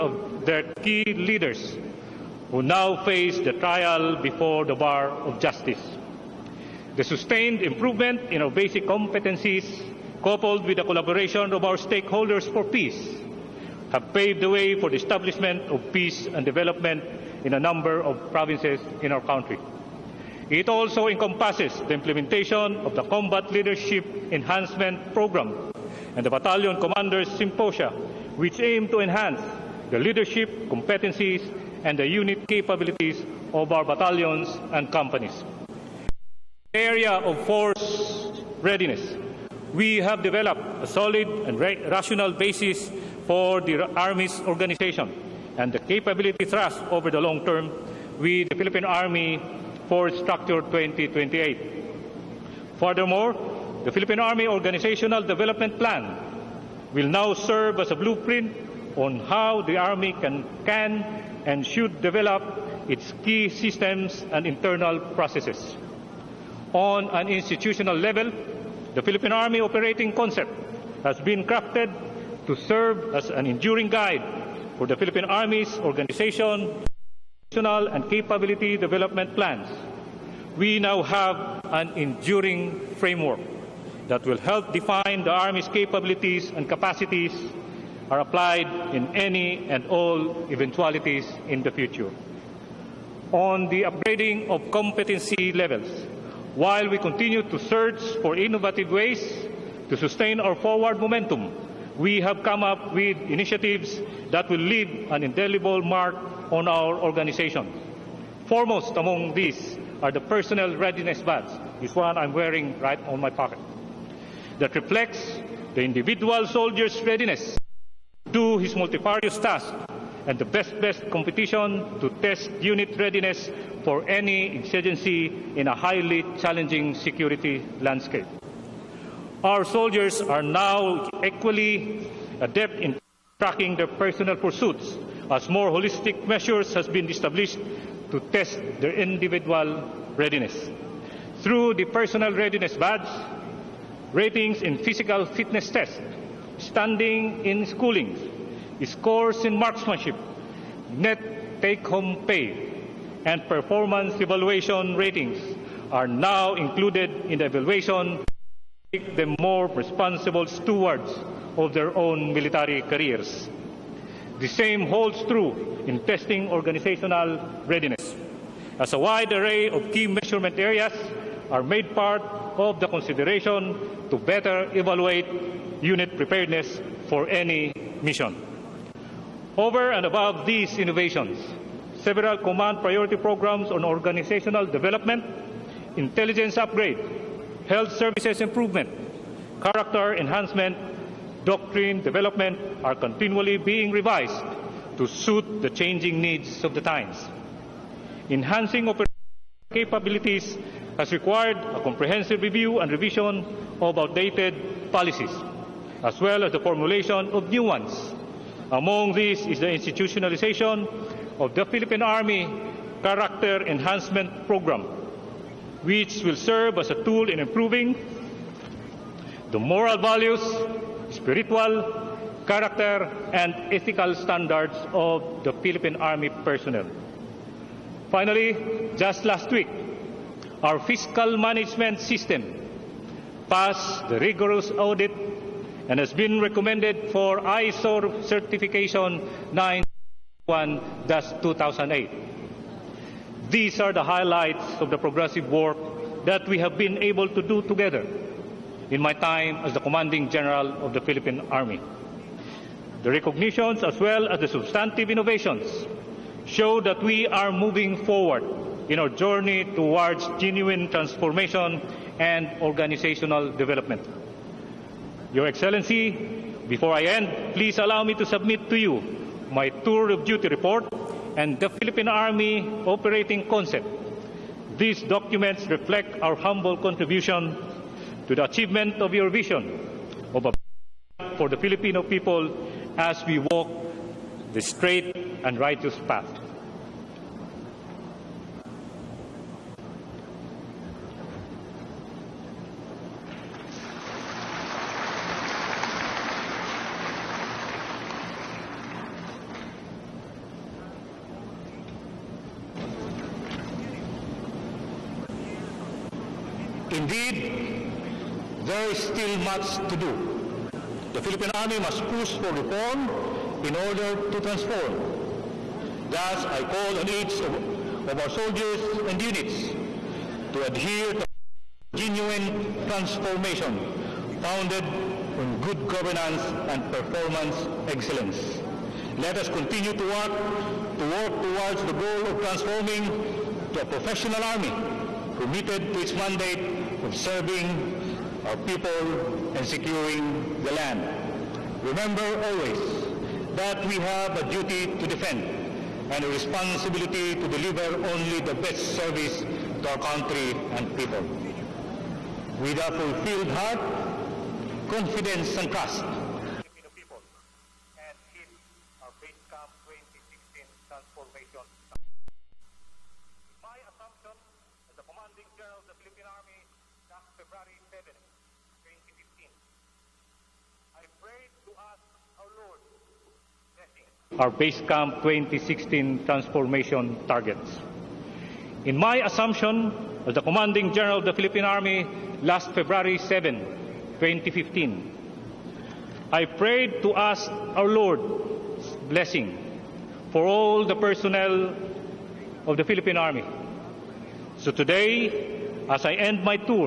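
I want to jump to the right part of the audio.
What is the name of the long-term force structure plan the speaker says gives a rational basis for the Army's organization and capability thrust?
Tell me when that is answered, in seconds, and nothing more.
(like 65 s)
48 s.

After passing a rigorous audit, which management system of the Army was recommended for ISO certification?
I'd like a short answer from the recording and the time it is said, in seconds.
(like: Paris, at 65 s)
fiscal management system, at 230 s.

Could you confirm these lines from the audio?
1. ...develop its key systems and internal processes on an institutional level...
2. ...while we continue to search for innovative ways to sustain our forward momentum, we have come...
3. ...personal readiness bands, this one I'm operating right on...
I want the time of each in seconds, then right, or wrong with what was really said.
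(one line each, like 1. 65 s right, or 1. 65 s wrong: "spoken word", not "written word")
1. 61 s right
2. 96 s right
3. 110 s wrong: "wearing", not "operating".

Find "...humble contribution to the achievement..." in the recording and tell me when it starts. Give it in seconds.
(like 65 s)
276 s.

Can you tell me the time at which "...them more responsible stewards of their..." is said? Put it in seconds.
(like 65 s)
159 s.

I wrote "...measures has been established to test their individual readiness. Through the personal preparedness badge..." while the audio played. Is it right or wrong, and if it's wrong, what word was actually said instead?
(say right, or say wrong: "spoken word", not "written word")
wrong: "readiness", not "preparedness".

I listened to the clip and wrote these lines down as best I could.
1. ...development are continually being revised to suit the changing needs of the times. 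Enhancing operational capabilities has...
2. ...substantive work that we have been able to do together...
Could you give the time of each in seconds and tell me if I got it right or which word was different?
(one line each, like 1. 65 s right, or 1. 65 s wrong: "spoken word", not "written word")
1. 191 s right
2. 244 s wrong: "progressive", not "substantive".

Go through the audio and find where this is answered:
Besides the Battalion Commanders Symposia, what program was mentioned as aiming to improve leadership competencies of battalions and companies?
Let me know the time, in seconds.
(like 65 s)
23 s.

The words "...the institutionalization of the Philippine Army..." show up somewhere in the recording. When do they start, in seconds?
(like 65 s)
209 s.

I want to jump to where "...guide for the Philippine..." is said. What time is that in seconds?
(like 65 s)
73 s.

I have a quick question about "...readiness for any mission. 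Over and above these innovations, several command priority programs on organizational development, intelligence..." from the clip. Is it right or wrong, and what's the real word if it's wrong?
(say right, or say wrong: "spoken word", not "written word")
wrong: "preparedness", not "readiness".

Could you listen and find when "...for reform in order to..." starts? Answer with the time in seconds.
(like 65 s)
312 s.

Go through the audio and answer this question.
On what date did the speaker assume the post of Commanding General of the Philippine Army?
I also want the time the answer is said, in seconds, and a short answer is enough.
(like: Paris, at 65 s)
February 7, 2015, at 382 s.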